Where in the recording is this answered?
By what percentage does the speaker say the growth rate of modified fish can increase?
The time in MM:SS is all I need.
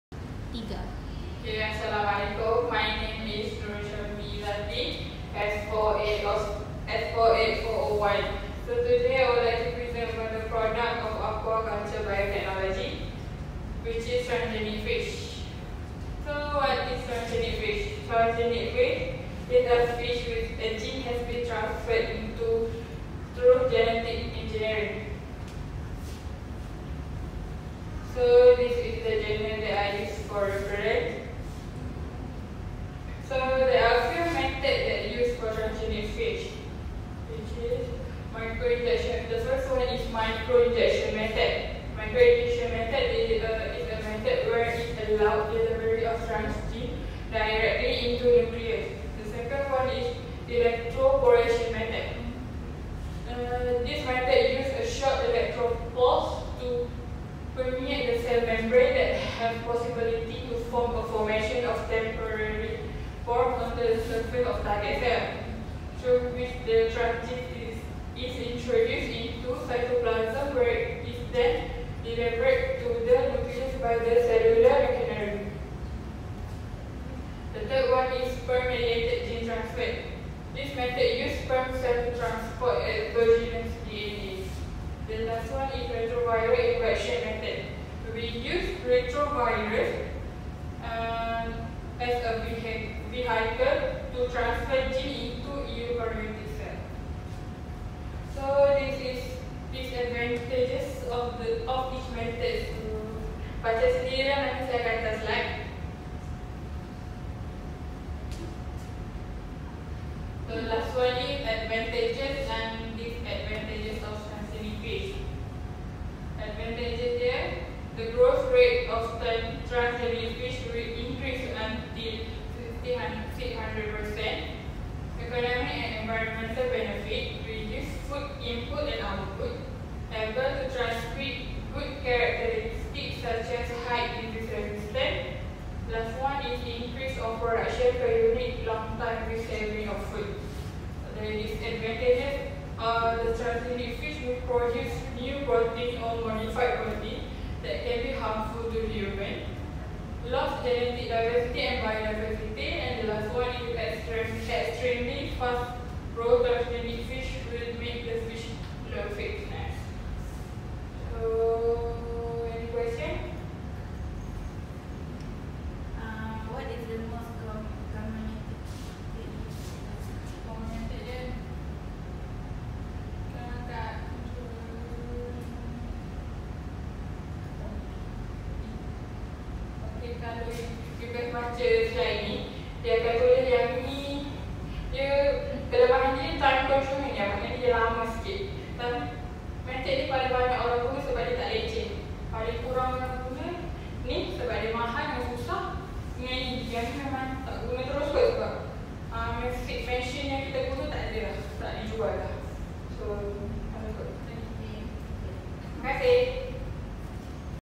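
02:02.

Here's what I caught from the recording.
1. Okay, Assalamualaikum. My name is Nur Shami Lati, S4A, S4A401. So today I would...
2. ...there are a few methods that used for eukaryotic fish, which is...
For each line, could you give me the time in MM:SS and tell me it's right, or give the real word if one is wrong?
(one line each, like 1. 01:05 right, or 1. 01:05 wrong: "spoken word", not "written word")
1. 00:01 right
2. 00:33 wrong: "transgenic", not "eukaryotic".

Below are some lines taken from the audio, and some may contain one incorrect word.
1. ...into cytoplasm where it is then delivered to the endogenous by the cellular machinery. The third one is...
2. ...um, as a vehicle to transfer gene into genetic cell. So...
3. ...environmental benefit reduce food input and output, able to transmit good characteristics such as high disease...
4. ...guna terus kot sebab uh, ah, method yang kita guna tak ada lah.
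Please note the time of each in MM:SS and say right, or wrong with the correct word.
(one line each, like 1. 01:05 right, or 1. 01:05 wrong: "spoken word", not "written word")
1. 01:09 wrong: "nucleus", not "endogenous"
2. 01:30 wrong: "eukaryotic", not "genetic"
3. 02:06 right
4. 03:17 right.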